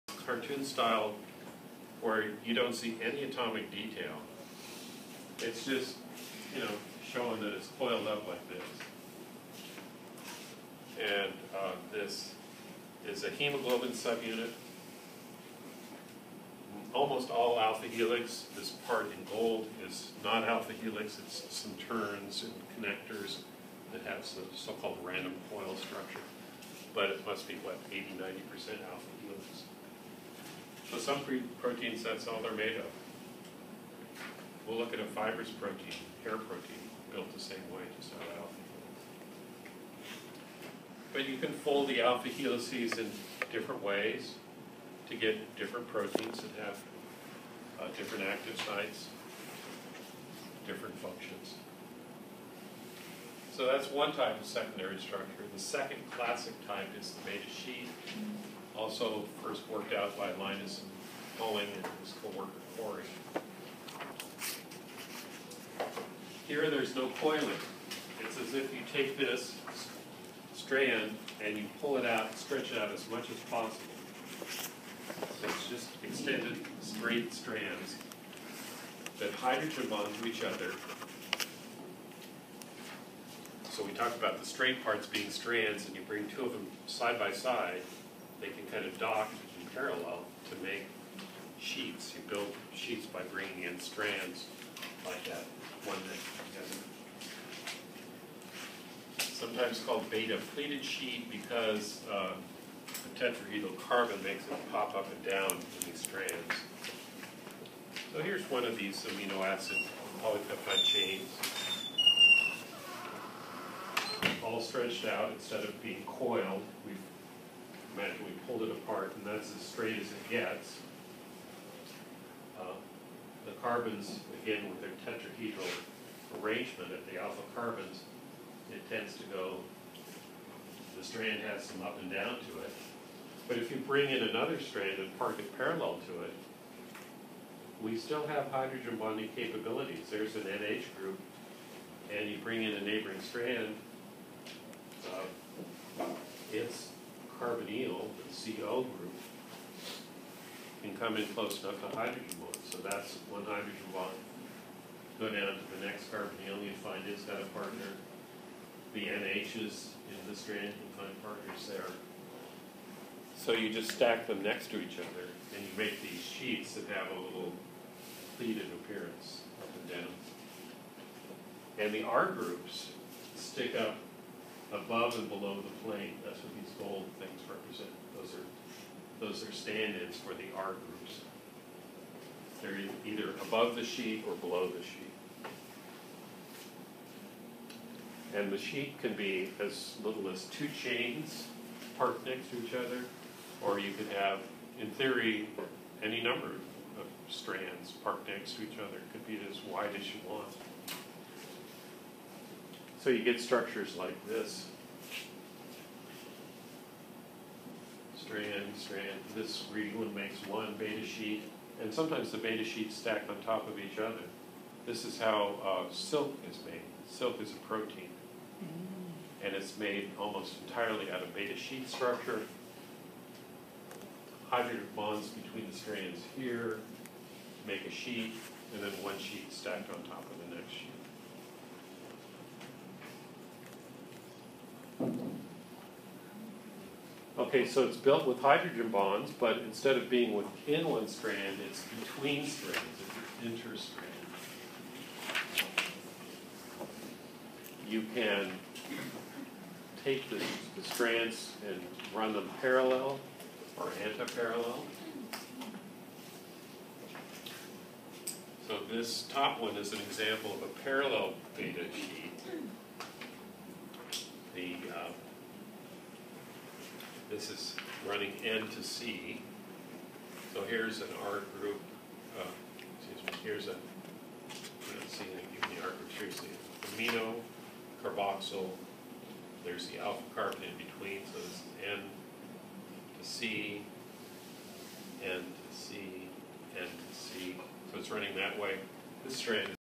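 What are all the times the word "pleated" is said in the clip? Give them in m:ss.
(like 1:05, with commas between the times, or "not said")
1:40, 2:48.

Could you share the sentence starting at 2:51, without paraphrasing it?
And the R groups stick up above and below the plane.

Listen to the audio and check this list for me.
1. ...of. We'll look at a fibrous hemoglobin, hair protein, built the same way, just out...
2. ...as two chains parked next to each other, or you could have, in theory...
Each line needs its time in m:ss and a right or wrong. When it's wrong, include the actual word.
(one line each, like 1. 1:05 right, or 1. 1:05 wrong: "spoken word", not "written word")
1. 0:32 wrong: "protein", not "hemoglobin"
2. 3:10 right.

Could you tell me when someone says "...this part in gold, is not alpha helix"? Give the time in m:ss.
0:18.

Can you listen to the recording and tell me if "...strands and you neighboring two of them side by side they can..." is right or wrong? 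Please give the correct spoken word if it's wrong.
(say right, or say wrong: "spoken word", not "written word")
wrong: "bring", not "neighboring".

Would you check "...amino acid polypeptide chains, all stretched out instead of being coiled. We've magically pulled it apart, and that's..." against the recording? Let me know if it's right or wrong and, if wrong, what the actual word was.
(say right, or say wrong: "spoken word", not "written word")
right.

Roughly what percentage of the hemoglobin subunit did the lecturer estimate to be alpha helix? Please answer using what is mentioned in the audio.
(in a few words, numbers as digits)
80-90%.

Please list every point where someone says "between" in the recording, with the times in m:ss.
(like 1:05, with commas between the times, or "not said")
3:45, 4:01, 4:40.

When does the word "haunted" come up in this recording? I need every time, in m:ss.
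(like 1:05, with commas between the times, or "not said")
not said.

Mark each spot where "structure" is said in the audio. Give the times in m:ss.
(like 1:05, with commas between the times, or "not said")
0:25, 0:54, 3:23, 3:41.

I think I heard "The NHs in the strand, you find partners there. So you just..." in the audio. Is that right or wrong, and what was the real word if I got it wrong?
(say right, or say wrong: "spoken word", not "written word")
right.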